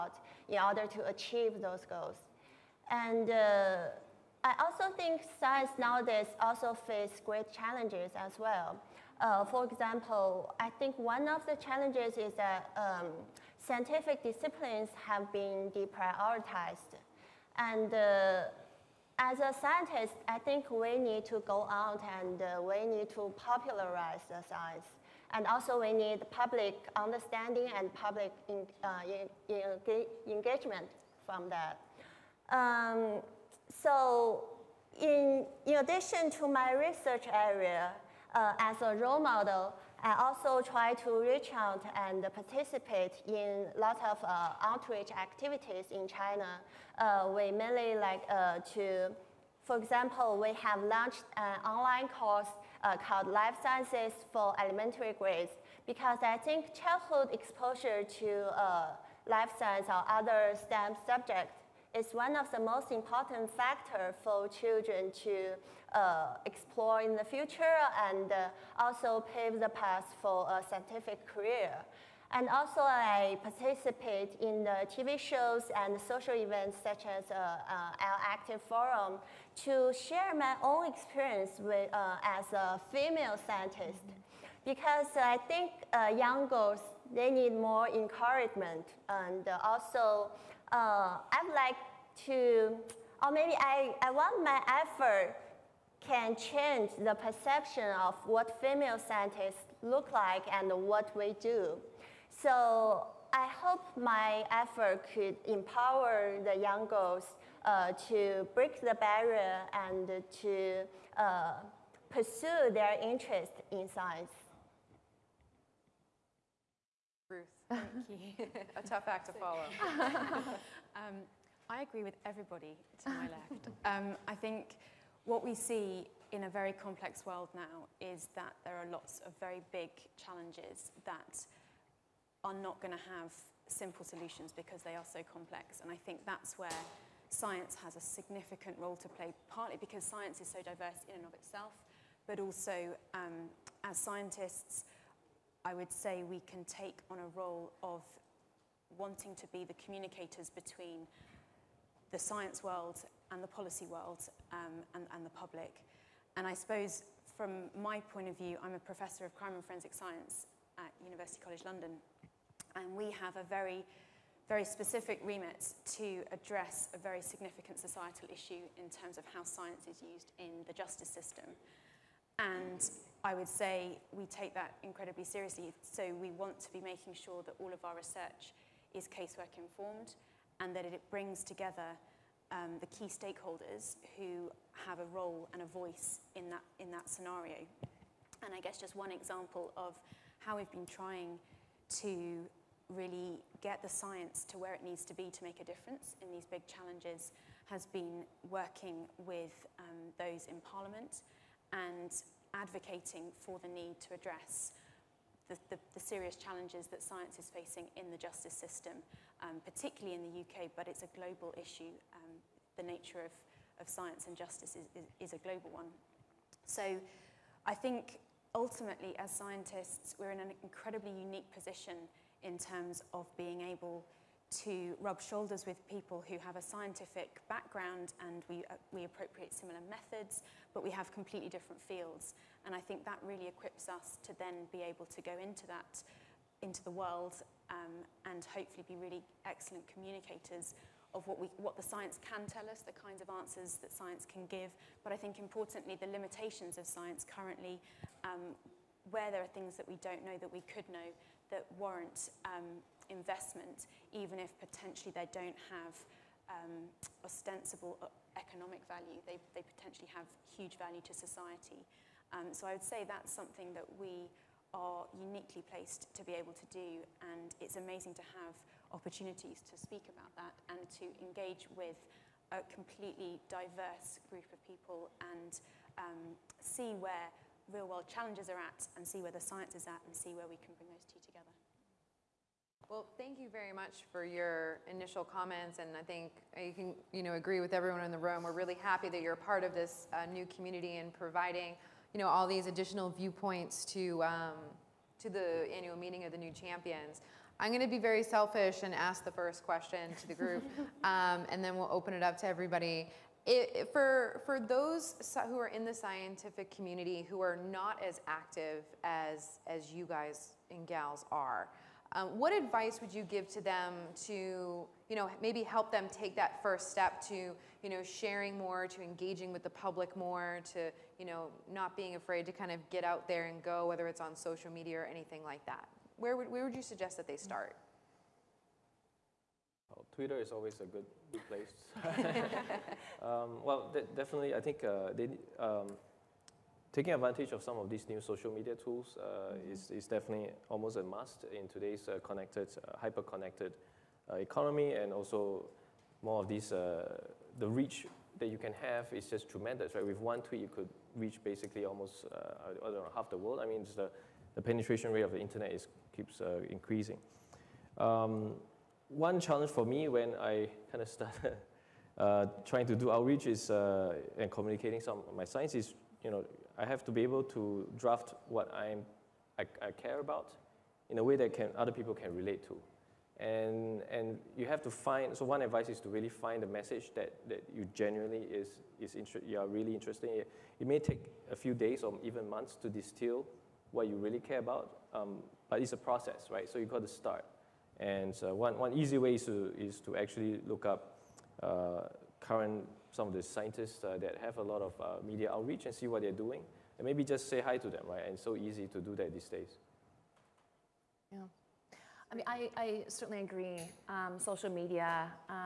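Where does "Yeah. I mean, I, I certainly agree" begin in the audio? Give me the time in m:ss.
6:41.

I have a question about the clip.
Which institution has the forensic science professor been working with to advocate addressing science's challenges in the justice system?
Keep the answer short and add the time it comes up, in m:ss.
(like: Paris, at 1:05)
Parliament, at 3:20.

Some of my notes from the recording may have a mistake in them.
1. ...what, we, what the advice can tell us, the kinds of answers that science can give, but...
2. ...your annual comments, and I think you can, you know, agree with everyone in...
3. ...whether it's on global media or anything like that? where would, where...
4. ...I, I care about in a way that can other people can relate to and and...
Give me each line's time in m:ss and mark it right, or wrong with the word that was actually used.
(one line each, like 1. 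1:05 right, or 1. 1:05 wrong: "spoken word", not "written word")
1. 4:01 wrong: "science", not "advice"
2. 4:44 wrong: "initial", not "annual"
3. 5:23 wrong: "social", not "global"
4. 6:09 right.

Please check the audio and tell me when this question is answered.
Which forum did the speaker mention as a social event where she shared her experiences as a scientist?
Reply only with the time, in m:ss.
1:18.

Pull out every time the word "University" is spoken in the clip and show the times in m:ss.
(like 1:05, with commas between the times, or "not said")
2:41.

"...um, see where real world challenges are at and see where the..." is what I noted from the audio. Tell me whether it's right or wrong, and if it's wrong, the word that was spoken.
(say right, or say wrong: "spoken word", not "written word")
right.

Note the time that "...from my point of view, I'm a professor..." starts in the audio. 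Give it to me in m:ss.
2:37.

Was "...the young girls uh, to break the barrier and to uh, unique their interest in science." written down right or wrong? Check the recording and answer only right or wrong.
wrong.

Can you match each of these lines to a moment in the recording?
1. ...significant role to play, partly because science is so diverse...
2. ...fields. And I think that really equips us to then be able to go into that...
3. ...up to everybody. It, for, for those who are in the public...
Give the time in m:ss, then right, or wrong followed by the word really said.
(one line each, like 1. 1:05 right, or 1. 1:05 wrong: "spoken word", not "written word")
1. 2:18 right
2. 3:51 right
3. 5:02 wrong: "scientific", not "public".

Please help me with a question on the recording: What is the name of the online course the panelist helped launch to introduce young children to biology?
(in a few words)
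Life Sciences for Elementary Grades.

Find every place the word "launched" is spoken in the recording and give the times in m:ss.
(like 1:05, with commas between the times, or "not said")
0:50.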